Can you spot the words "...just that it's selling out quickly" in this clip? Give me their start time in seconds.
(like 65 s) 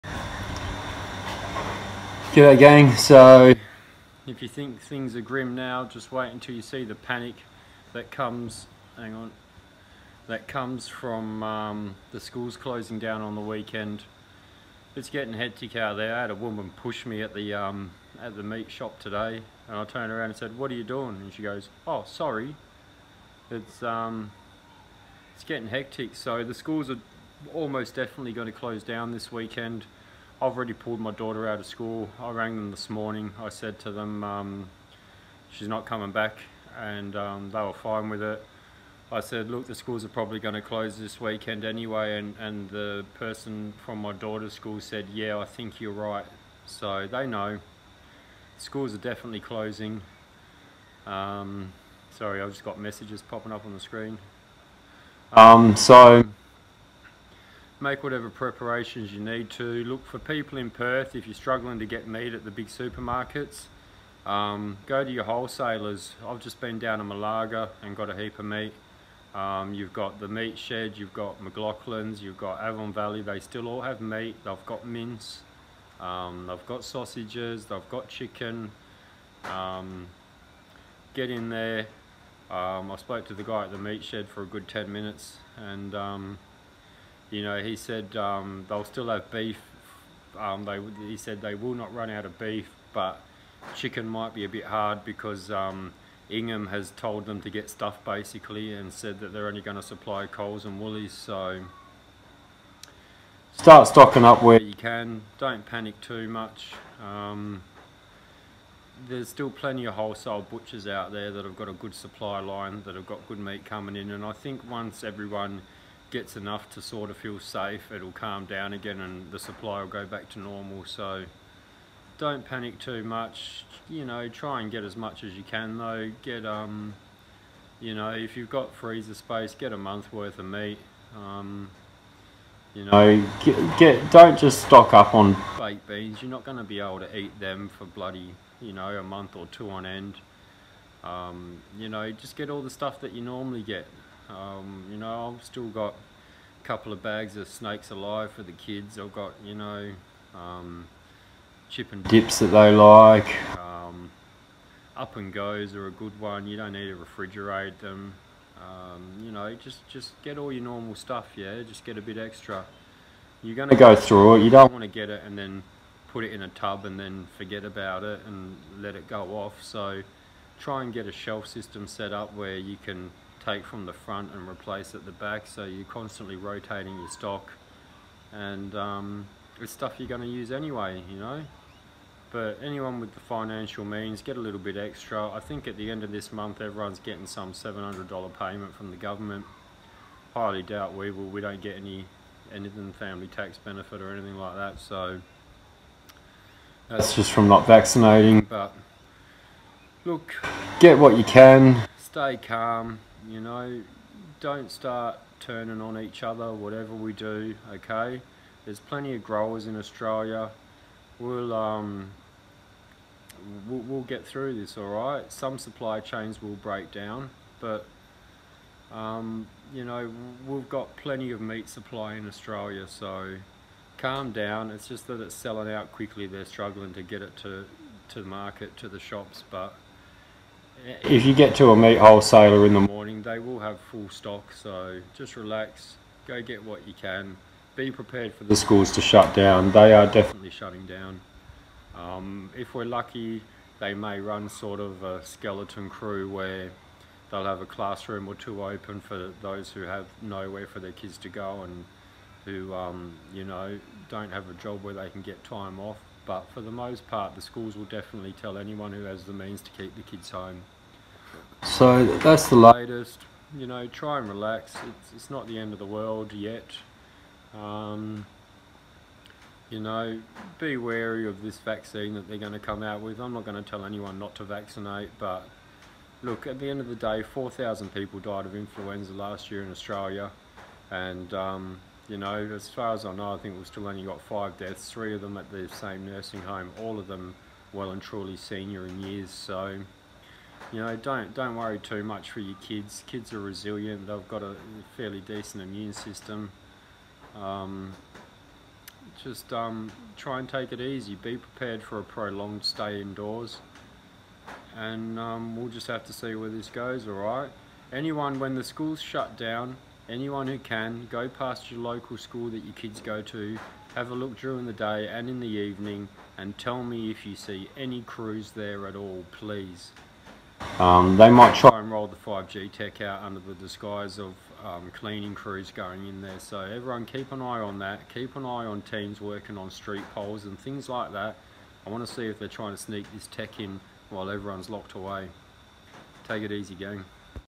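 224 s.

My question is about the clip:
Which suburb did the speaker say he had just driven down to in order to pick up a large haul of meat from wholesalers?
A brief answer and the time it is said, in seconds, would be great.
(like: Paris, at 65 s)
Malaga, at 67 s.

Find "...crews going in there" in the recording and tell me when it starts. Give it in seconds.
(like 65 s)
325 s.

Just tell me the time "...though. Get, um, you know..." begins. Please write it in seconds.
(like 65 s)
125 s.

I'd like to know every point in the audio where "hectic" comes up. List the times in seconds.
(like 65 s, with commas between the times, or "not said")
15 s, 25 s.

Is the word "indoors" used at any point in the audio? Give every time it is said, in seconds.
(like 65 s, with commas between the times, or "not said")
303 s.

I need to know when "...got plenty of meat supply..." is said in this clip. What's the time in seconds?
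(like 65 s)
220 s.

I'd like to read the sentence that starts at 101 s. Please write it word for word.
So start stocking up where you can.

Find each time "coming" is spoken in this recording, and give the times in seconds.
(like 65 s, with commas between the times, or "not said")
35 s, 113 s.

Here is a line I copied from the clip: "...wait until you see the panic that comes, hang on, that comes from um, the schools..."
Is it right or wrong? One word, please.
right.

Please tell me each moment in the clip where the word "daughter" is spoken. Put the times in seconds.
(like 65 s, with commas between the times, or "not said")
31 s, 44 s.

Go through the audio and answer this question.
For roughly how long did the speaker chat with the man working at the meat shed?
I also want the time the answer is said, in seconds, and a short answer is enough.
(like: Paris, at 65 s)
10 minutes, at 84 s.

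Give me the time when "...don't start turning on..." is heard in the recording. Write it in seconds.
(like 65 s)
204 s.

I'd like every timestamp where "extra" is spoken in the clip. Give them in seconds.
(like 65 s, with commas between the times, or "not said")
162 s, 184 s.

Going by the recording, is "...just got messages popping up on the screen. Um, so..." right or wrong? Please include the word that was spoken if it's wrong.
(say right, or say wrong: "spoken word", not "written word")
right.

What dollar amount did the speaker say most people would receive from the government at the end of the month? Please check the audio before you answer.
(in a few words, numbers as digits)
$700.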